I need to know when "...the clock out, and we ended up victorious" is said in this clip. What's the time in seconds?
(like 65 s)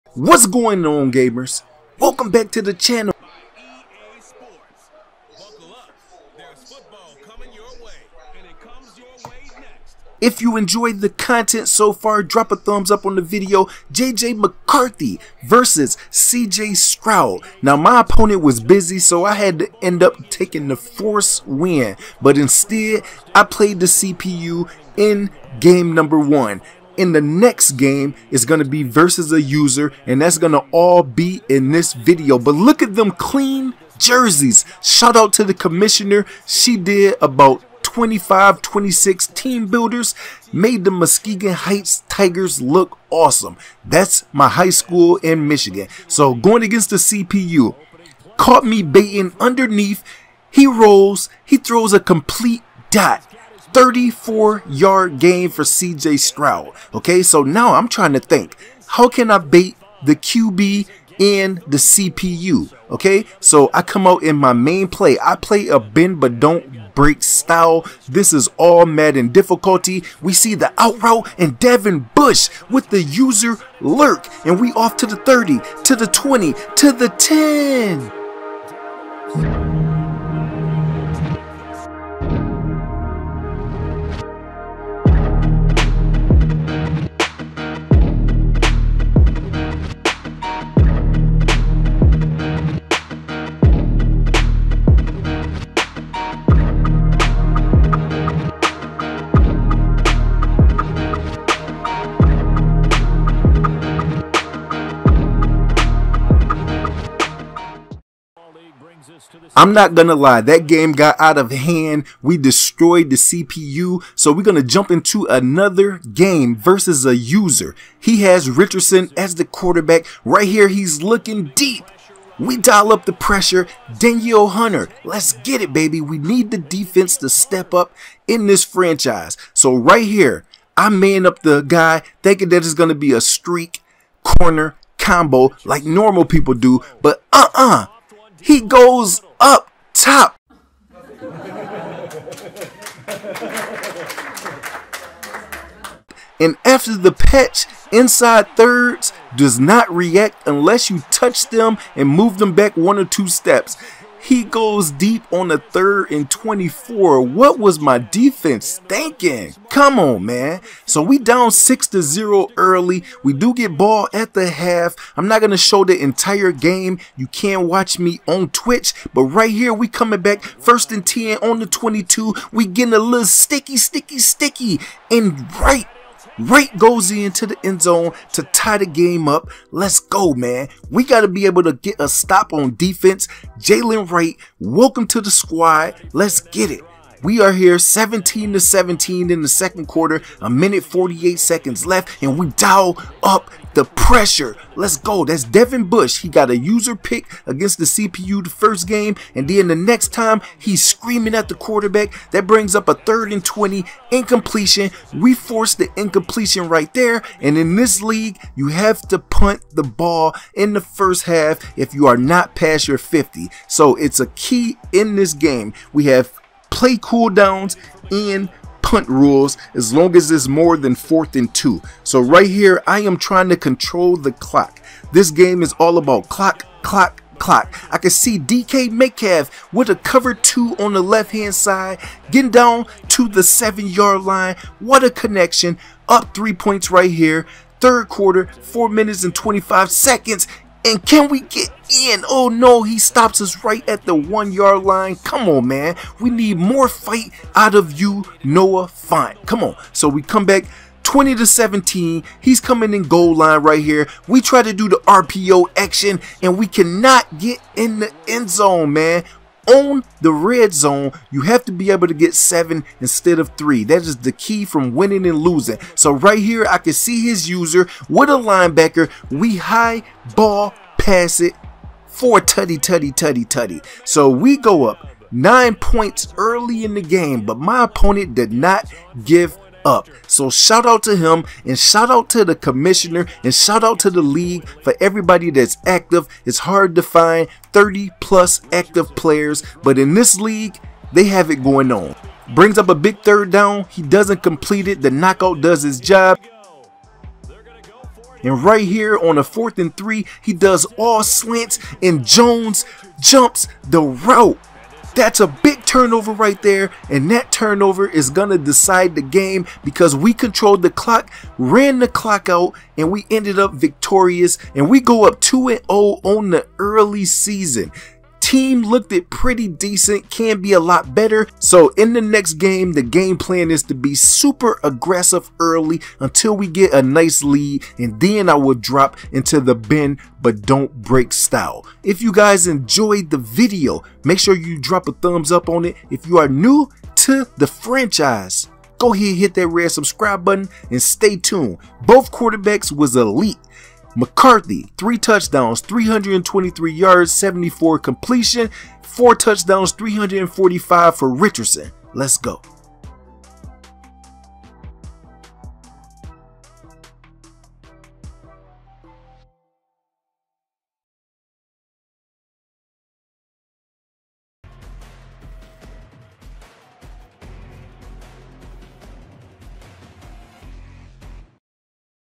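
311 s.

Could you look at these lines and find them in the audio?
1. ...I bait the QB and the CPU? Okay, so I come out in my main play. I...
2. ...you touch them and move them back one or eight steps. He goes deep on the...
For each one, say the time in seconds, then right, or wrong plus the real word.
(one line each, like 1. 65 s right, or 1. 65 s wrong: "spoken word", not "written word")
1. 59 s right
2. 150 s wrong: "two", not "eight".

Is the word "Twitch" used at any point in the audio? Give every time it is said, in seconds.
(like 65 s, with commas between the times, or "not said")
168 s.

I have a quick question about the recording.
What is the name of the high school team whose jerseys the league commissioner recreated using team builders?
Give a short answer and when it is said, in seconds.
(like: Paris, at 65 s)
Muskegon Heights Tigers, at 40 s.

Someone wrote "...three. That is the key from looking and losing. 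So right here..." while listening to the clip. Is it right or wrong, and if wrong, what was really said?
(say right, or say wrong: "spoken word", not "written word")
wrong: "winning", not "looking".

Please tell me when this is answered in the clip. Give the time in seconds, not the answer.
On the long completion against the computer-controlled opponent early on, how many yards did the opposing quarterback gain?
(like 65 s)
53 s.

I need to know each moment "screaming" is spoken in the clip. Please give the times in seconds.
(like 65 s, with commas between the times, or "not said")
200 s.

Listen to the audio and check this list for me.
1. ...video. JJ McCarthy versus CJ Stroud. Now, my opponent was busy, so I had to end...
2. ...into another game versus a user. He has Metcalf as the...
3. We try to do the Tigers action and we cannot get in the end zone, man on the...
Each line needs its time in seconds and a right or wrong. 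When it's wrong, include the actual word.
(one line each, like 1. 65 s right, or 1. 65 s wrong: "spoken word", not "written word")
1. 13 s right
2. 114 s wrong: "Richardson", not "Metcalf"
3. 254 s wrong: "RPO", not "Tigers".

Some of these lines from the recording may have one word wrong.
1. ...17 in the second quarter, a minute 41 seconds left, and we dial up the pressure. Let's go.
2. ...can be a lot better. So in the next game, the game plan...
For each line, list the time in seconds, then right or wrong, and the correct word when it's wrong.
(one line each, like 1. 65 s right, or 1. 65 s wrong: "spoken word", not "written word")
1. 188 s wrong: "48", not "41"
2. 320 s right.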